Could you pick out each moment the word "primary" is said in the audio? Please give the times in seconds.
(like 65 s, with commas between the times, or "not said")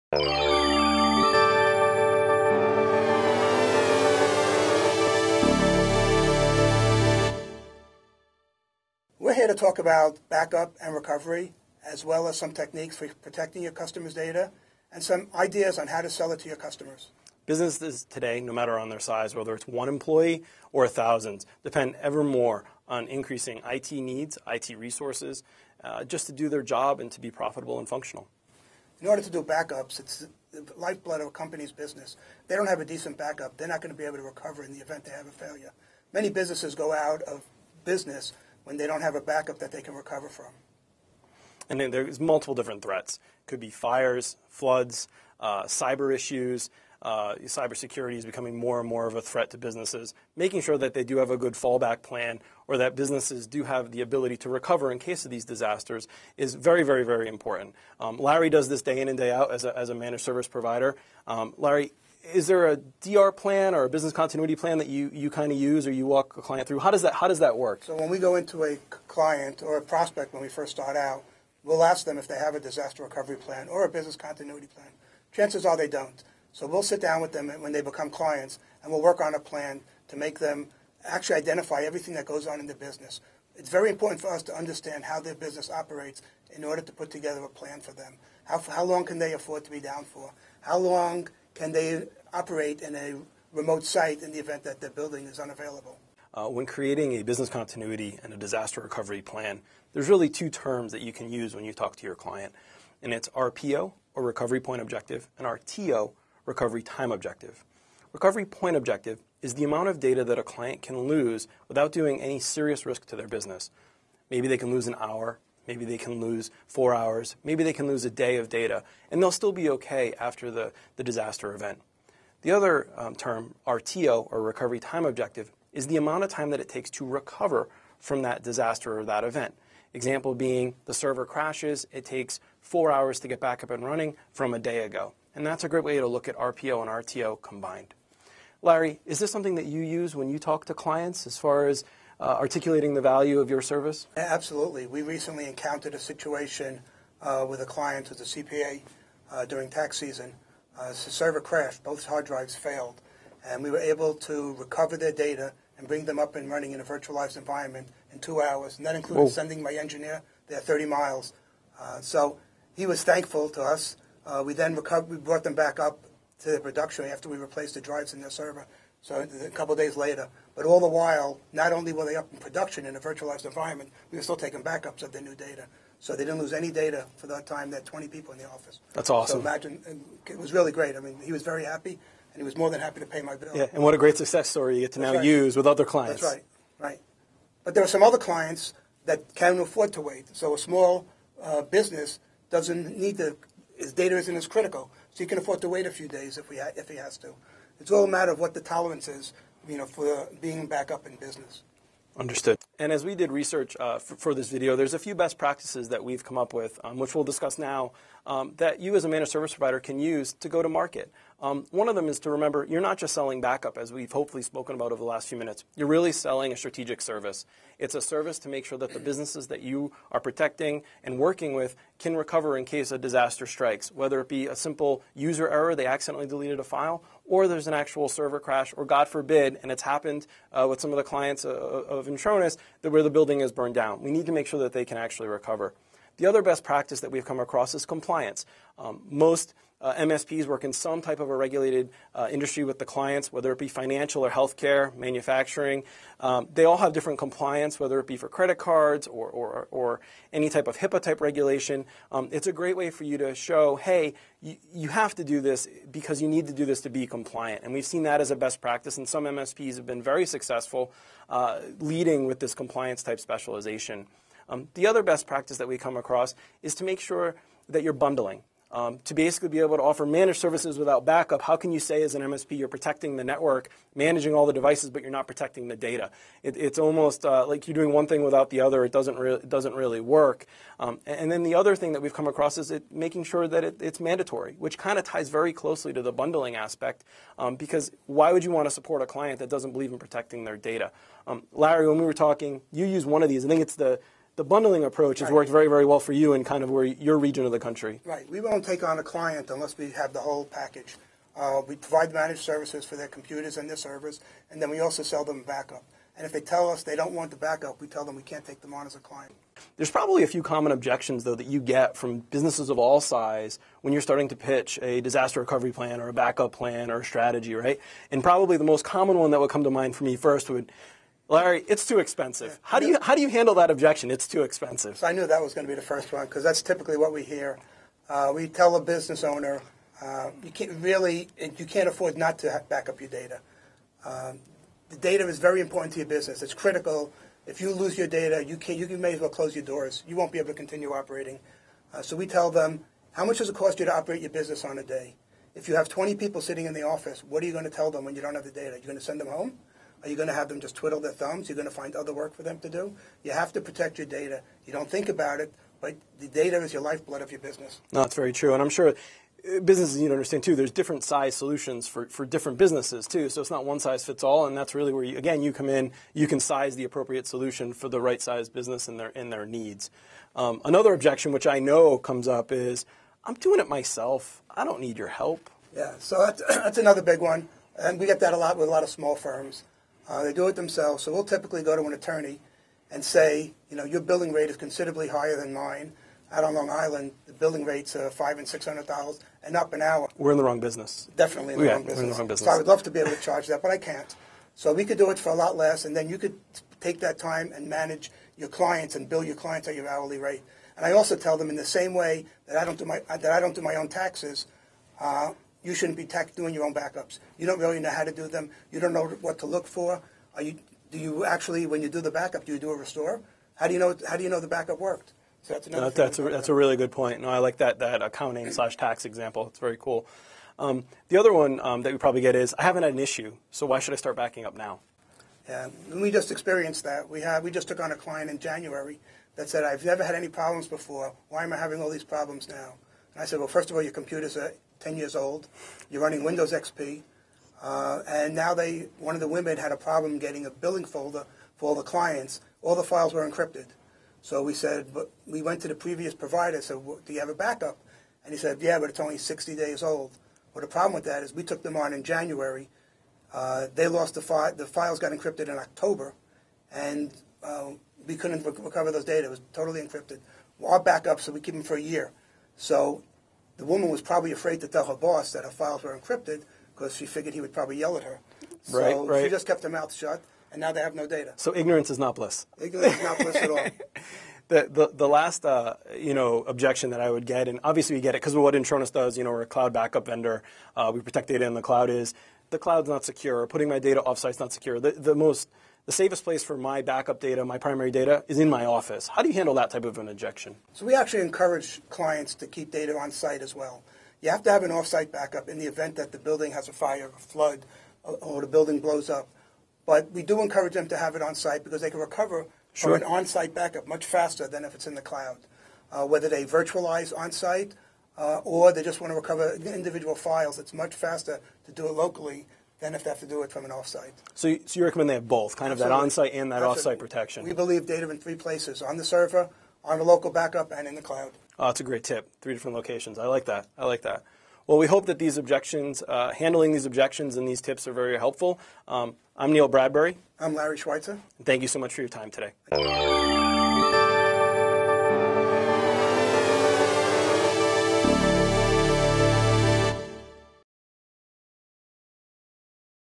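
487 s.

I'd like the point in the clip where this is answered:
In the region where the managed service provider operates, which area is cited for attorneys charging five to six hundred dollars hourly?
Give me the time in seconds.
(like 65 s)
386 s.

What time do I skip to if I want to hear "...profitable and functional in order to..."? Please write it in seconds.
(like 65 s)
27 s.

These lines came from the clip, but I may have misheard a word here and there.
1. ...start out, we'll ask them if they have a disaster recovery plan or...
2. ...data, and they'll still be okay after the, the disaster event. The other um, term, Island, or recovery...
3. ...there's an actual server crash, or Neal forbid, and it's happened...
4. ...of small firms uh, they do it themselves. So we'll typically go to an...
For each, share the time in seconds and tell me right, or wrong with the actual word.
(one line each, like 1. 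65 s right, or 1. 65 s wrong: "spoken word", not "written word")
1. 70 s right
2. 118 s wrong: "RTO", not "Island"
3. 227 s wrong: "God", not "Neal"
4. 378 s right.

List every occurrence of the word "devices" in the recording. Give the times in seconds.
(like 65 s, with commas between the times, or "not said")
274 s.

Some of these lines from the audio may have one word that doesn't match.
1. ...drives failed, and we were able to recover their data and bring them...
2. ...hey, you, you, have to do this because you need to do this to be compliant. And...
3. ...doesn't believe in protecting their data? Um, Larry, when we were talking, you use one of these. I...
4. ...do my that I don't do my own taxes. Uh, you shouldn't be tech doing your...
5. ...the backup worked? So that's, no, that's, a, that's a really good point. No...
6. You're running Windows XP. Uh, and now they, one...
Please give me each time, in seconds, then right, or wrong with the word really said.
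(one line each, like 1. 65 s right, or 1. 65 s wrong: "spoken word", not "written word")
1. 152 s right
2. 253 s right
3. 289 s right
4. 402 s right
5. 414 s right
6. 435 s right.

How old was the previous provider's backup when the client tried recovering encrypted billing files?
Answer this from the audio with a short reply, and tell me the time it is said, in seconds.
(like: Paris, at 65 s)
60 days, at 449 s.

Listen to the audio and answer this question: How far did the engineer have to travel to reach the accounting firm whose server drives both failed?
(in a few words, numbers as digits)
30 miles.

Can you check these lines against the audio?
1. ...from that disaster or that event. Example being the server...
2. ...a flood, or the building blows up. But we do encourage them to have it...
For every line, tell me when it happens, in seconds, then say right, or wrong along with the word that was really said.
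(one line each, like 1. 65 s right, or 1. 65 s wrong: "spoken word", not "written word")
1. 127 s right
2. 497 s right.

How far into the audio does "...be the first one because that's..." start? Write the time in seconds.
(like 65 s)
325 s.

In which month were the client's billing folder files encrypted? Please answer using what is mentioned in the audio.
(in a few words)
October.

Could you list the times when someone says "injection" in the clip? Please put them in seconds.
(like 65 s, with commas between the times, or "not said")
490 s.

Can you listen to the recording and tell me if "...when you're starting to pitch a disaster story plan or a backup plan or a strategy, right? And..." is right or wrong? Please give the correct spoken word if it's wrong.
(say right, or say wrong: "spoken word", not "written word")
wrong: "recovery", not "story".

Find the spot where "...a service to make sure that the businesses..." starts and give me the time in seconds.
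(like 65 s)
217 s.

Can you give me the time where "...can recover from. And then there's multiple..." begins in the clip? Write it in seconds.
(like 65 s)
39 s.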